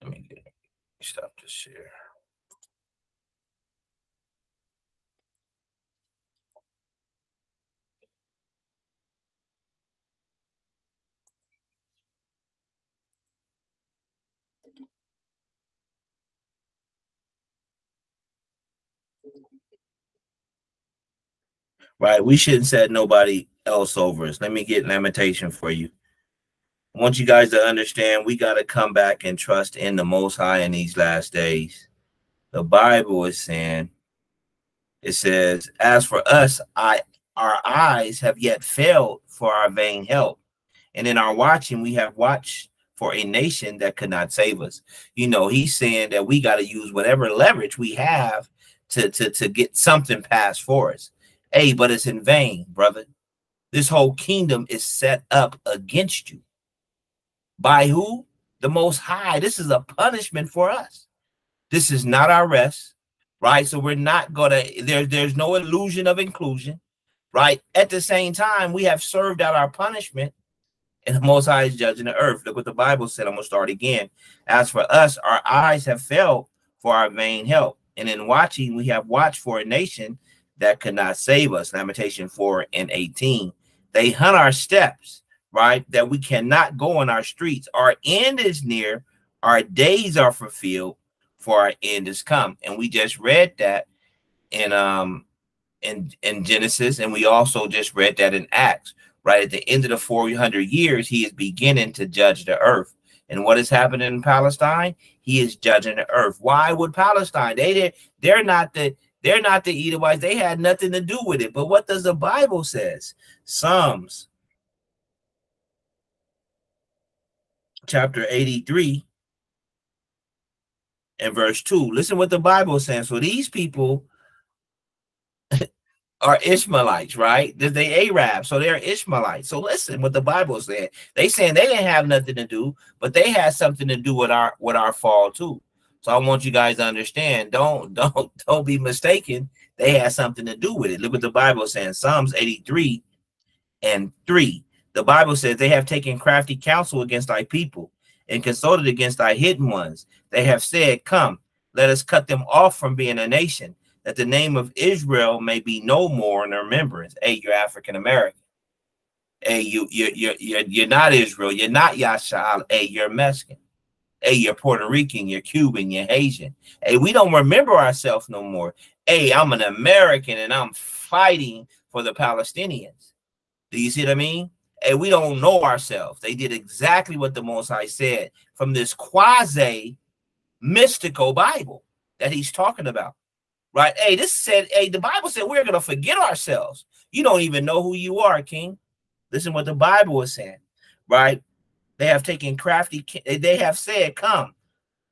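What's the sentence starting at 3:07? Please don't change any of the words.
You don't even know who you are, King.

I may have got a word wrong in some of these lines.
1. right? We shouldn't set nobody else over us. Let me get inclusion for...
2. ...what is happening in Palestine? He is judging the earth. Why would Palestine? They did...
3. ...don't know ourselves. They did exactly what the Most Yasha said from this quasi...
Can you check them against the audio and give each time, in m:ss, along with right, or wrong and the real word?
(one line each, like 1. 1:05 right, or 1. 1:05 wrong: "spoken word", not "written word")
1. 0:21 wrong: "lamentation", not "inclusion"
2. 1:43 right
3. 2:55 wrong: "High", not "Yasha".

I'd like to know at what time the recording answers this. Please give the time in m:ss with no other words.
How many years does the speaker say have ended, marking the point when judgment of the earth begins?
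1:39.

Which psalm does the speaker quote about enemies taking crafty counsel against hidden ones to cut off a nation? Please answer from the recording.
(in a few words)
Psalms 83.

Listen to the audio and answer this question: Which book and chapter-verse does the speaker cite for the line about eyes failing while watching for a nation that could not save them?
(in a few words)
Lamentations 4:18.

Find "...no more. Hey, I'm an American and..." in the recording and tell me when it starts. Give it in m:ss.
2:48.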